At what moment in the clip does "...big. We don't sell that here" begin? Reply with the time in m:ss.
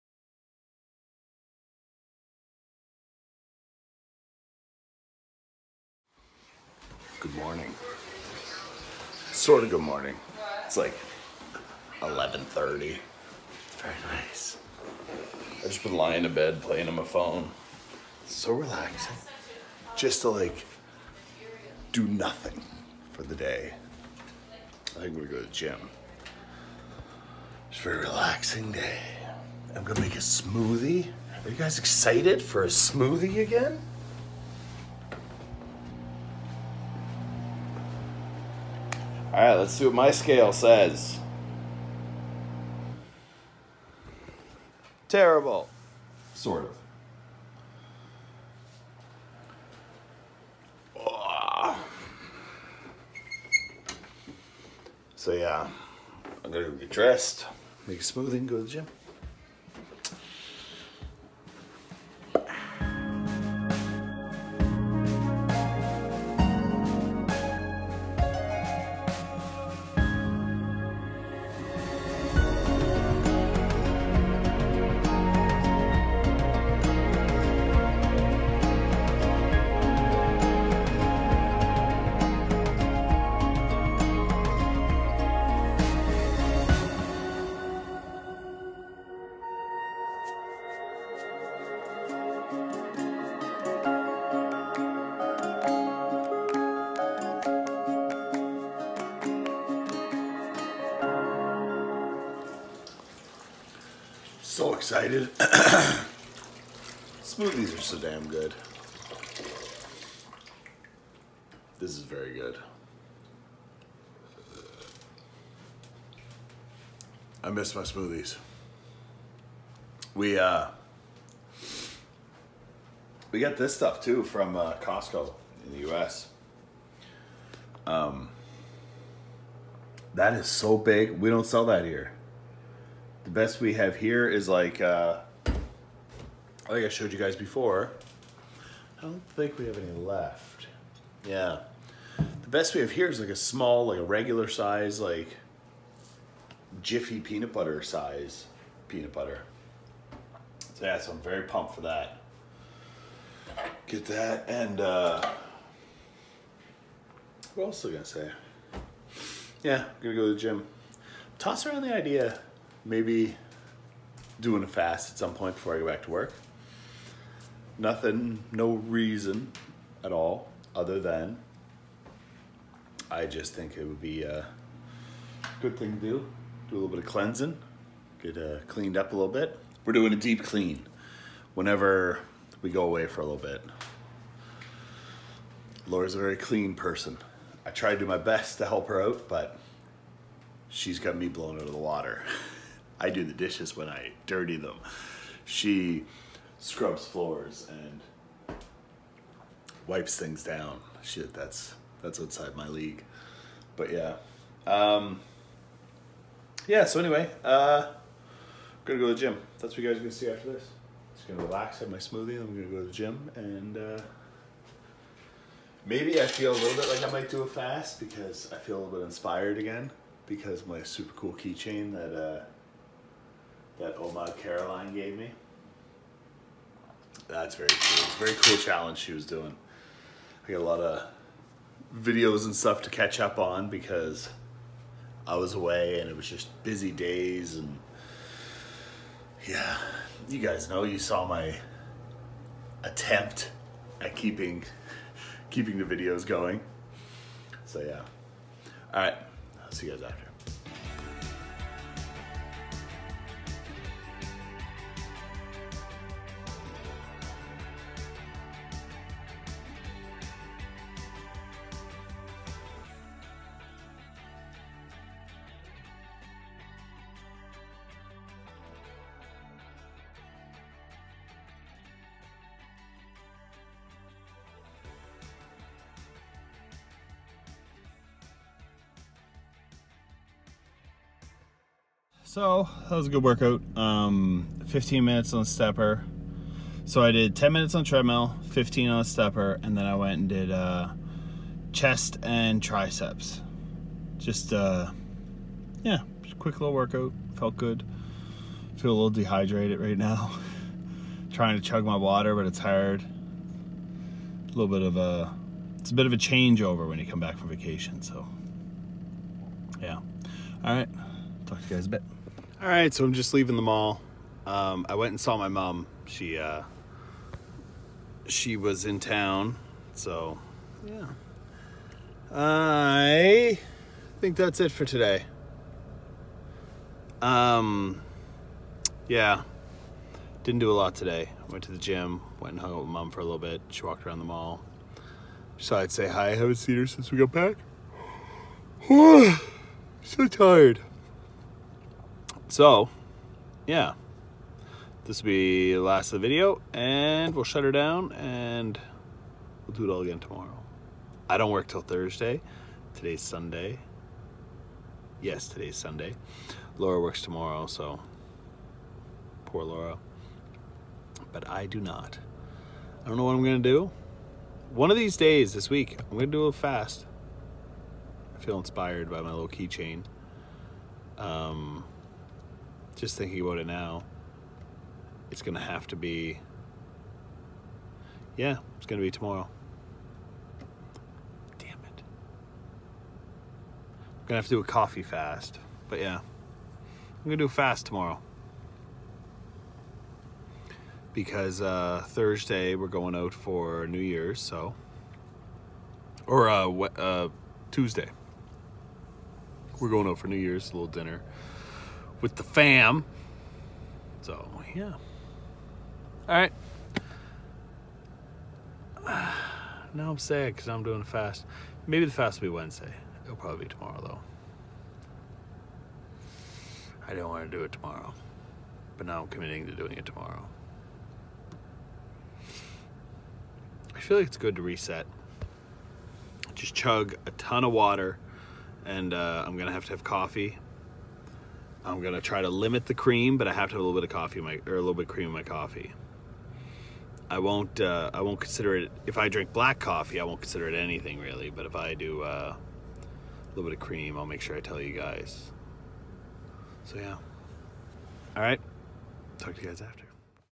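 2:10.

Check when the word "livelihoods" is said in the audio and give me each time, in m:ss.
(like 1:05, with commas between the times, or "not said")
not said.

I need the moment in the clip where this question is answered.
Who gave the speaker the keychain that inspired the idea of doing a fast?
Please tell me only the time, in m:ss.
3:43.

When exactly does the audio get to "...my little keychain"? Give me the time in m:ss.
6:09.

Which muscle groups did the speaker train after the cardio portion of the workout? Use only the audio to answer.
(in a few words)
Chest and triceps.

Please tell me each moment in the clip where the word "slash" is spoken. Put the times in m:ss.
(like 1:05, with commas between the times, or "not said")
not said.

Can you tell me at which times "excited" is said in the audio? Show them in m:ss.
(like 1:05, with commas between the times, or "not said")
0:31, 1:44.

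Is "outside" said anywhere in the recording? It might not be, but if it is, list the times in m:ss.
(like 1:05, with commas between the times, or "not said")
3:22.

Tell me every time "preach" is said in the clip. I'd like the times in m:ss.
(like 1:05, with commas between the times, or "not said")
not said.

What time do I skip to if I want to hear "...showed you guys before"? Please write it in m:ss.
2:16.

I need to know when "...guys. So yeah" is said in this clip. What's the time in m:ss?
7:24.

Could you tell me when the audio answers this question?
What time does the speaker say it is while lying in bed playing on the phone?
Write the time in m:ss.
0:12.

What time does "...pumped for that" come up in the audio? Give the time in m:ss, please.
2:31.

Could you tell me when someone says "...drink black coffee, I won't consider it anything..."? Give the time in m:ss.
7:19.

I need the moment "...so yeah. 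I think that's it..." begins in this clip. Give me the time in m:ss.
5:19.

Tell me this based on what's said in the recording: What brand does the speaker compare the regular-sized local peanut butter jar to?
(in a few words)
Jiffy.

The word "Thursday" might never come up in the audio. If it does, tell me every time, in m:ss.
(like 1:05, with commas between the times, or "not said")
5:51, 6:32.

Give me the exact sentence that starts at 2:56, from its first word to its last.
Do a little bit of cleansing, get uh, cleaned up a little bit.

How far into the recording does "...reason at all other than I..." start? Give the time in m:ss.
2:48.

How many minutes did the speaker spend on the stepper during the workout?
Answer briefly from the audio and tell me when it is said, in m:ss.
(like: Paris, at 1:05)
15 minutes, at 4:44.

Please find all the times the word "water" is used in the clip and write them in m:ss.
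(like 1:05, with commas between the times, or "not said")
3:11, 5:01, 7:07.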